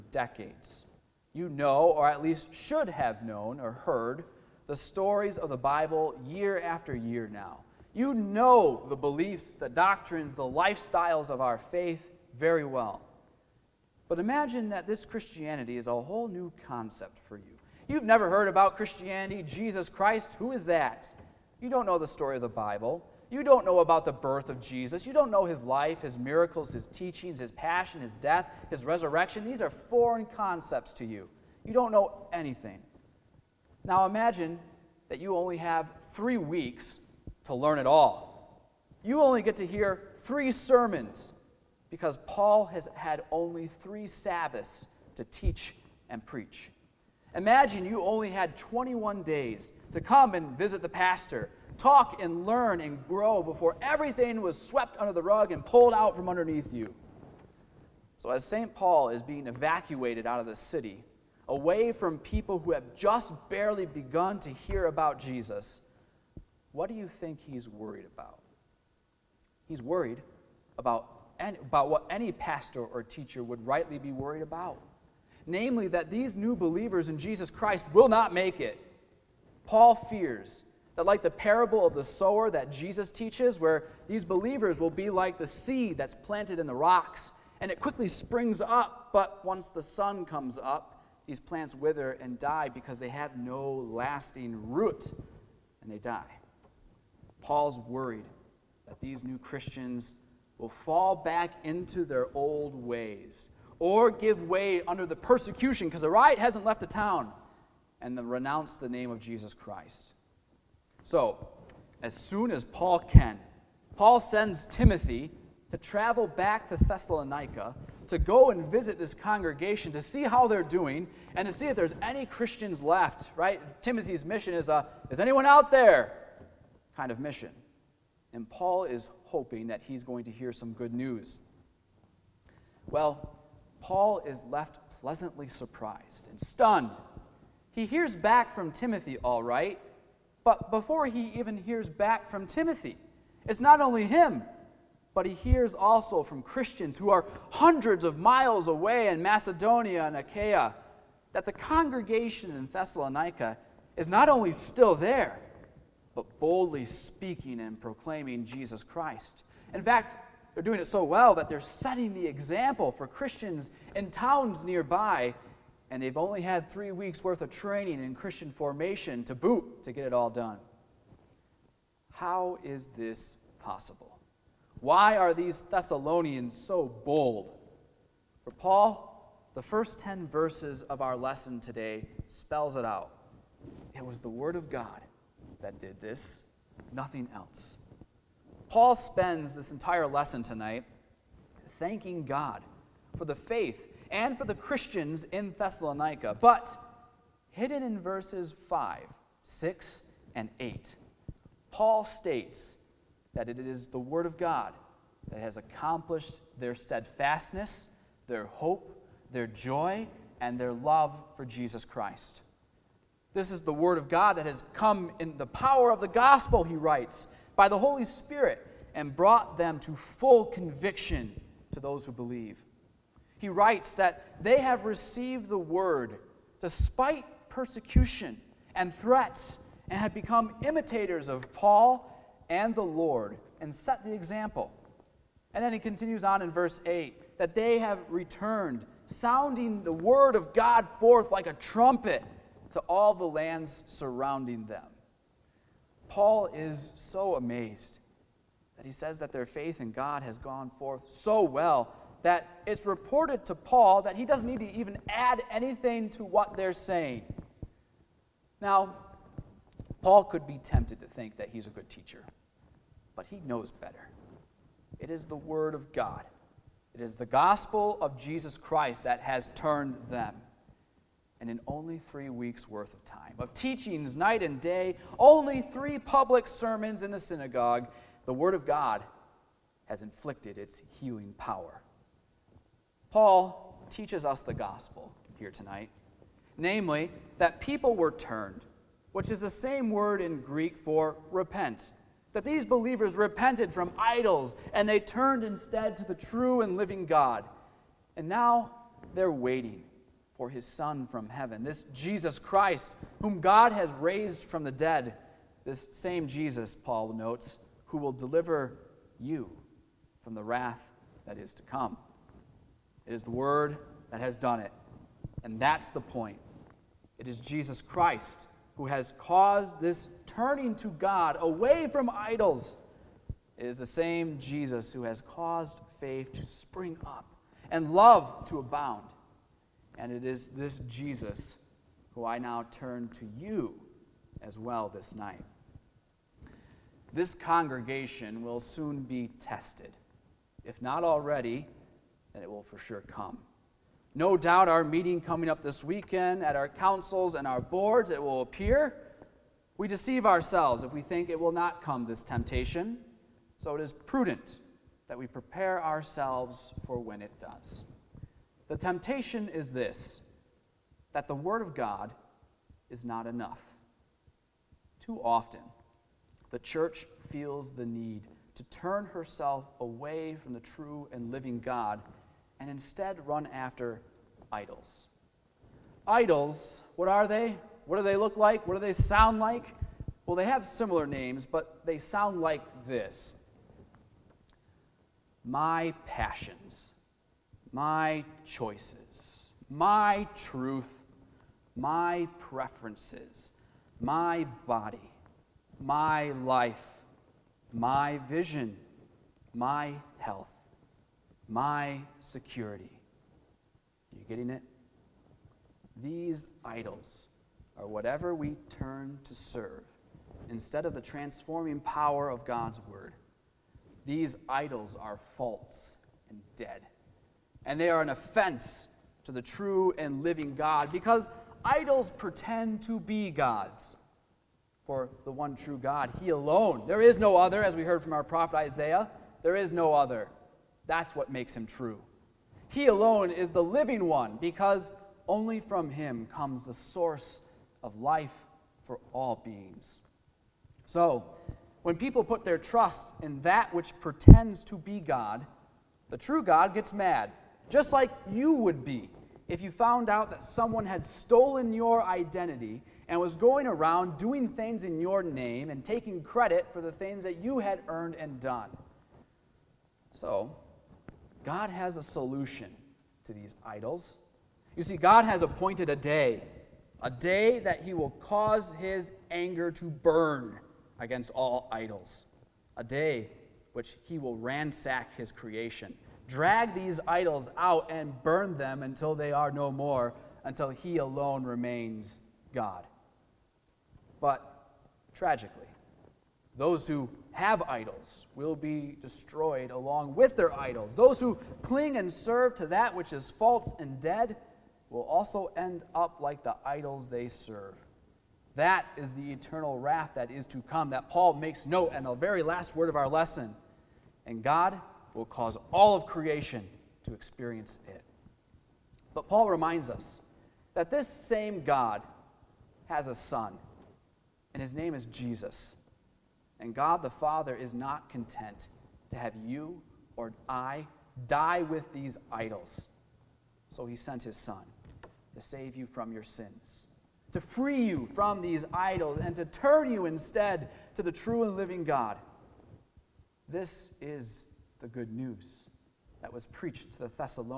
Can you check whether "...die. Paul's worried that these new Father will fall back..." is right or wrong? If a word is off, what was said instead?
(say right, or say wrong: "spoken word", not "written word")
wrong: "Christians", not "Father".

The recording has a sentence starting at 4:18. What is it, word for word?
Now, Paul could be tempted to think that he's a good teacher, but he knows better.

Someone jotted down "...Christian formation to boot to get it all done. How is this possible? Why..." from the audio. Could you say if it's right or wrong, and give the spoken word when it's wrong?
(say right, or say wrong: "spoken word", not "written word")
right.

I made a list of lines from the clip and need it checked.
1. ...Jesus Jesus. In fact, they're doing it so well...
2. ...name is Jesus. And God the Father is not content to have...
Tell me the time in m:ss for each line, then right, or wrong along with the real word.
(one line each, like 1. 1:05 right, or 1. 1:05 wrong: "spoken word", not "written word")
1. 2:38 wrong: "Christ", not "Jesus"
2. 8:34 right.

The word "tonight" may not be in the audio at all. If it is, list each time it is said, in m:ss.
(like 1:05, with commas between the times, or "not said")
3:10, 4:45.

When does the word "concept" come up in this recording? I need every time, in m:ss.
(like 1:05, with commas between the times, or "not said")
0:16, 0:30.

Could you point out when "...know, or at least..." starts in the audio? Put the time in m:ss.
0:01.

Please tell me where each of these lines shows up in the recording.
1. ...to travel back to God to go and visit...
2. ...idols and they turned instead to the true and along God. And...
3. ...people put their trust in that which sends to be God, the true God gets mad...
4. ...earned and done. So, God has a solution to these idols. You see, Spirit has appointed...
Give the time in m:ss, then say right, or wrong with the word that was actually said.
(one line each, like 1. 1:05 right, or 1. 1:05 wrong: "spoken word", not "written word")
1. 1:55 wrong: "Thessalonica", not "God"
2. 4:53 wrong: "living", not "along"
3. 7:21 wrong: "pretends", not "sends"
4. 7:37 wrong: "God", not "Spirit".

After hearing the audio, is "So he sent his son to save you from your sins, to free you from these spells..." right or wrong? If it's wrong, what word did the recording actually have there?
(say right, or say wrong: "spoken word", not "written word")
wrong: "idols", not "spells".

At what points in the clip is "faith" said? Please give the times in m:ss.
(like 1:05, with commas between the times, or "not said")
0:11, 3:13, 4:09, 5:25.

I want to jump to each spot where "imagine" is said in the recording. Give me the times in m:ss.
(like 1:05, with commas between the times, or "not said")
0:14, 0:34, 0:47.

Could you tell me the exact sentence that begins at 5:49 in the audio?
We deceive ourselves if we think it will not come this temptation.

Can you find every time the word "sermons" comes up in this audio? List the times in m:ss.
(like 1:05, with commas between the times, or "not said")
0:40, 4:36.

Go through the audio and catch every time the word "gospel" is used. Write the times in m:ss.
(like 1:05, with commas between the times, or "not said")
3:36, 4:27, 4:44.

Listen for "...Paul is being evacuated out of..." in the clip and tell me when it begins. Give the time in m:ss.
0:58.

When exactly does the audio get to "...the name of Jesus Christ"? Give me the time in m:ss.
1:48.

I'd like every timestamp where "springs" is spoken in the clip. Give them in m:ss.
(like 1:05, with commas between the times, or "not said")
1:28, 5:26.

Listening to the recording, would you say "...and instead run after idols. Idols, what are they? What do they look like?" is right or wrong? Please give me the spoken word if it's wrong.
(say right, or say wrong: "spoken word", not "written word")
right.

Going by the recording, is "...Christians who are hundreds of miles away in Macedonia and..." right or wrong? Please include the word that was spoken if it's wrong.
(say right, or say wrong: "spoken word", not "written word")
right.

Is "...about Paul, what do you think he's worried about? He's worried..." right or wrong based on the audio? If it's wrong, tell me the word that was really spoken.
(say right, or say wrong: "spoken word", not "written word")
wrong: "Jesus", not "Paul".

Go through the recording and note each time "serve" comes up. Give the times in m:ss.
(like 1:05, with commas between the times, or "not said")
6:49, 8:12, 8:17.